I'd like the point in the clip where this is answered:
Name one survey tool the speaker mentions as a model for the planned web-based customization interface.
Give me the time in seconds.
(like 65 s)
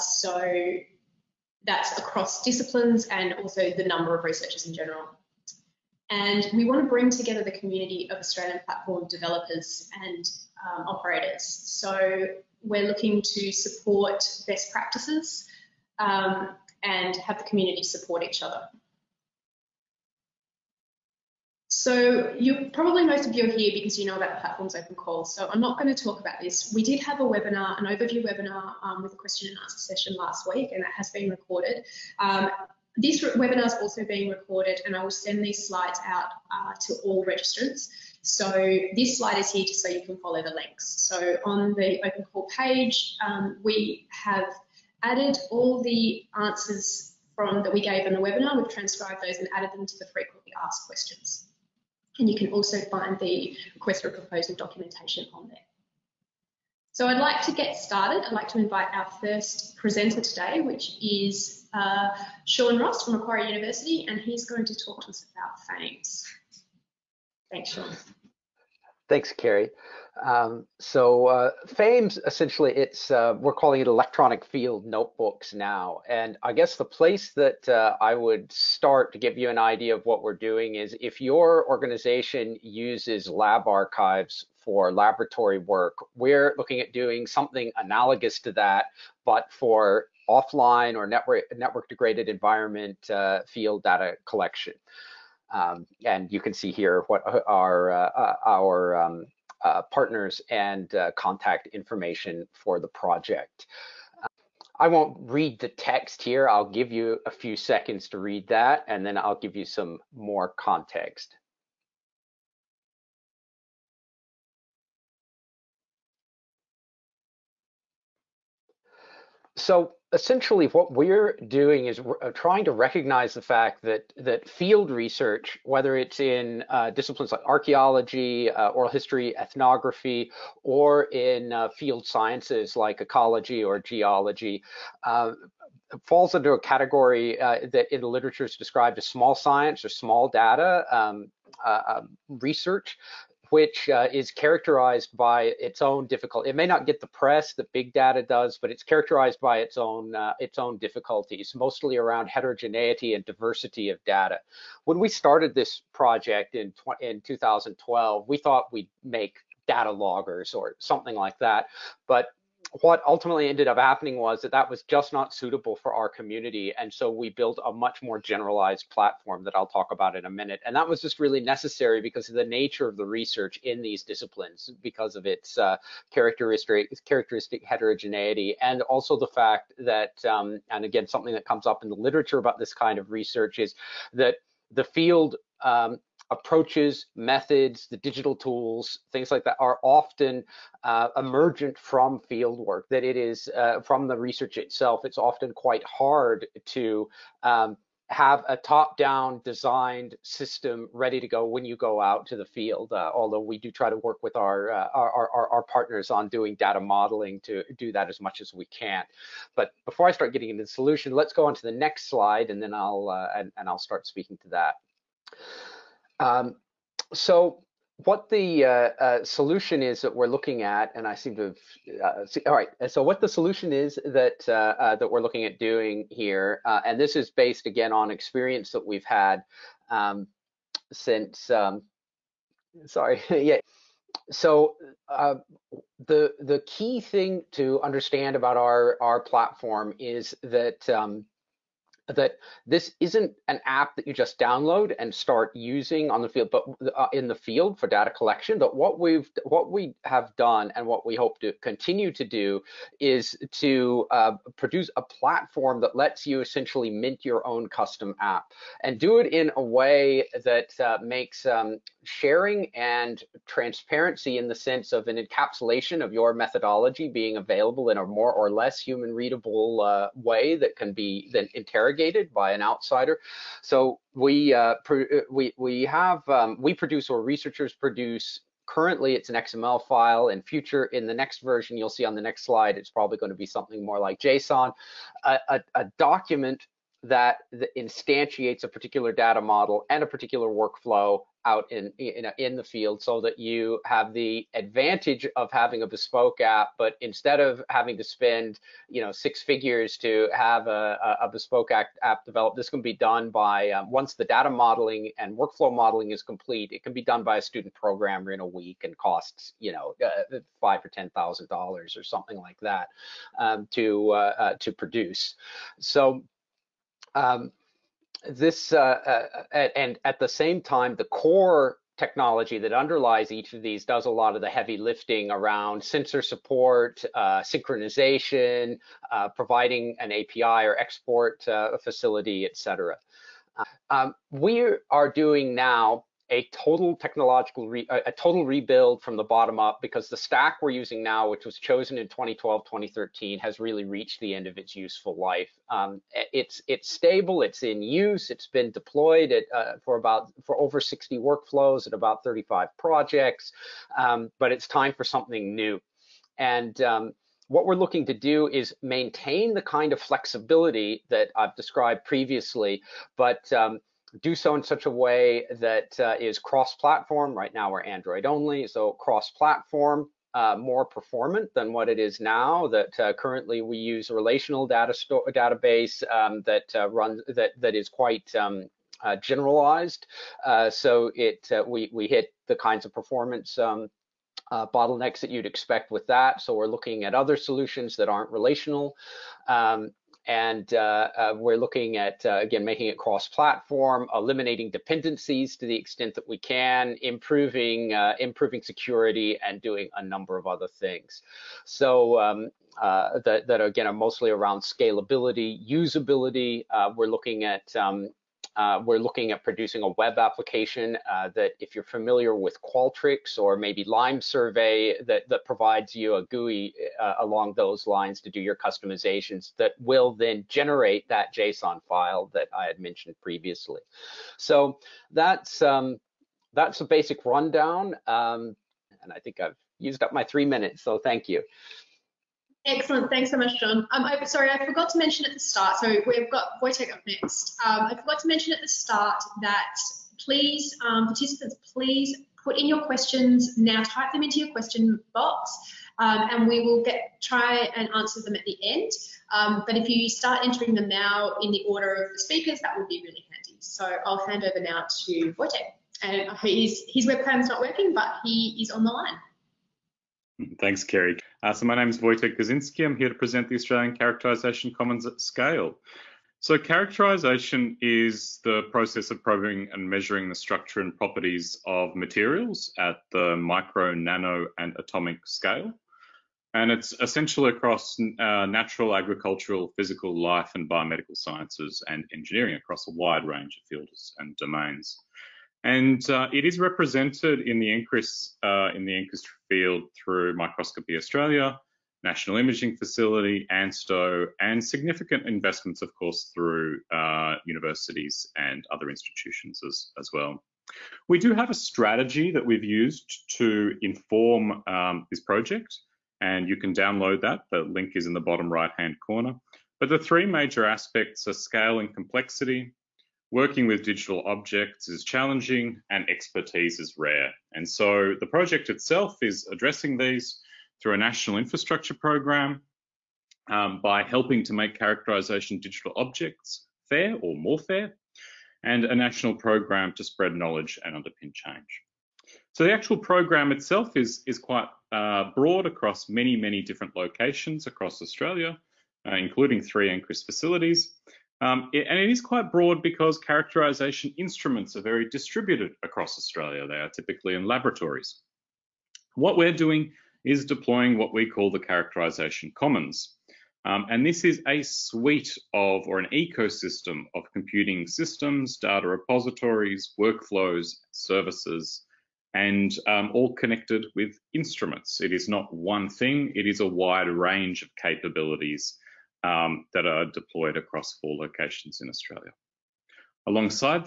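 412 s.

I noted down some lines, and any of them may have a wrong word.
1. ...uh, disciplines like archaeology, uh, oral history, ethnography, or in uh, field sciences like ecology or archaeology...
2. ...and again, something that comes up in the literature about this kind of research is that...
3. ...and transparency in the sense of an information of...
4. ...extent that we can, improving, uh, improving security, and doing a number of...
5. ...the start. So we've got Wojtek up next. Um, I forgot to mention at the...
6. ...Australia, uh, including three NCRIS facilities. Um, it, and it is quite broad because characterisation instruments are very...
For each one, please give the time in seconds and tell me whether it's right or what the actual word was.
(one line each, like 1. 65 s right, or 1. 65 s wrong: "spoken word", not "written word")
1. 126 s wrong: "geology", not "archaeology"
2. 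180 s right
3. 262 s wrong: "encapsulation", not "information"
4. 395 s right
5. 435 s right
6. 537 s right.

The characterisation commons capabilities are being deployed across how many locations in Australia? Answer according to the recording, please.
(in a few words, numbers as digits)
4.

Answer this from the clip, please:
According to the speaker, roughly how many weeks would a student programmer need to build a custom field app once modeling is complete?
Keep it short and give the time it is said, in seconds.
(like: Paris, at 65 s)
1, at 308 s.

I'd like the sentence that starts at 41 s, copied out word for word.
So on the open call page, um, we have added all the answers from that we gave in the webinar.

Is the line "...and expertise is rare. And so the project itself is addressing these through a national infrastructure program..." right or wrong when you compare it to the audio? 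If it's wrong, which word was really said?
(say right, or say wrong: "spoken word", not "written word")
right.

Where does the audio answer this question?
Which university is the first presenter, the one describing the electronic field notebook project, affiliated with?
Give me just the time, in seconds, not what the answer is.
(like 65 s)
63 s.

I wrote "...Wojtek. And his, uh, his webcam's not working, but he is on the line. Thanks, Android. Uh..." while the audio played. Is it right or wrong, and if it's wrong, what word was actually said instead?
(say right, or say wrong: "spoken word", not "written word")
wrong: "Kerry", not "Android".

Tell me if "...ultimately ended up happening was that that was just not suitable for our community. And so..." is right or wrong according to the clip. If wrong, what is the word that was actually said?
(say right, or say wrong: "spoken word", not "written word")
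right.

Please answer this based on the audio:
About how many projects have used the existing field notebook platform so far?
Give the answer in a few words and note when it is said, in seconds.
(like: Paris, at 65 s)
35, at 351 s.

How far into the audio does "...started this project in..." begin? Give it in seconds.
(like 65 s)
155 s.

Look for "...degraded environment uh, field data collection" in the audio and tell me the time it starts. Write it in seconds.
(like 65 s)
91 s.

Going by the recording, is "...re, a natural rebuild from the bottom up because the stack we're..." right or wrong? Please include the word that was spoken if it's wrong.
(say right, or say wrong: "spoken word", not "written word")
wrong: "total", not "natural".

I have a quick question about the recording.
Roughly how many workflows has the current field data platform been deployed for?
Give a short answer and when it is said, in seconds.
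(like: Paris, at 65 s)
over 60, at 350 s.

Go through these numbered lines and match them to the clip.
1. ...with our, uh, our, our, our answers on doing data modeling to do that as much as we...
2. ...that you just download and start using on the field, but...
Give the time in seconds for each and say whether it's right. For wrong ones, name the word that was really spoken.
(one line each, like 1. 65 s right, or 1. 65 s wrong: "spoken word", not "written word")
1. 204 s wrong: "partners", not "answers"
2. 243 s right.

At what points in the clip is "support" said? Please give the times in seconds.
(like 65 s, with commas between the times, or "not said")
13 s, 17 s, 326 s.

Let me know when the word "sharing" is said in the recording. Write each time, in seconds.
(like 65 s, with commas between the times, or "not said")
262 s.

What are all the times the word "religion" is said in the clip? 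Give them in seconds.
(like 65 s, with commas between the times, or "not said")
not said.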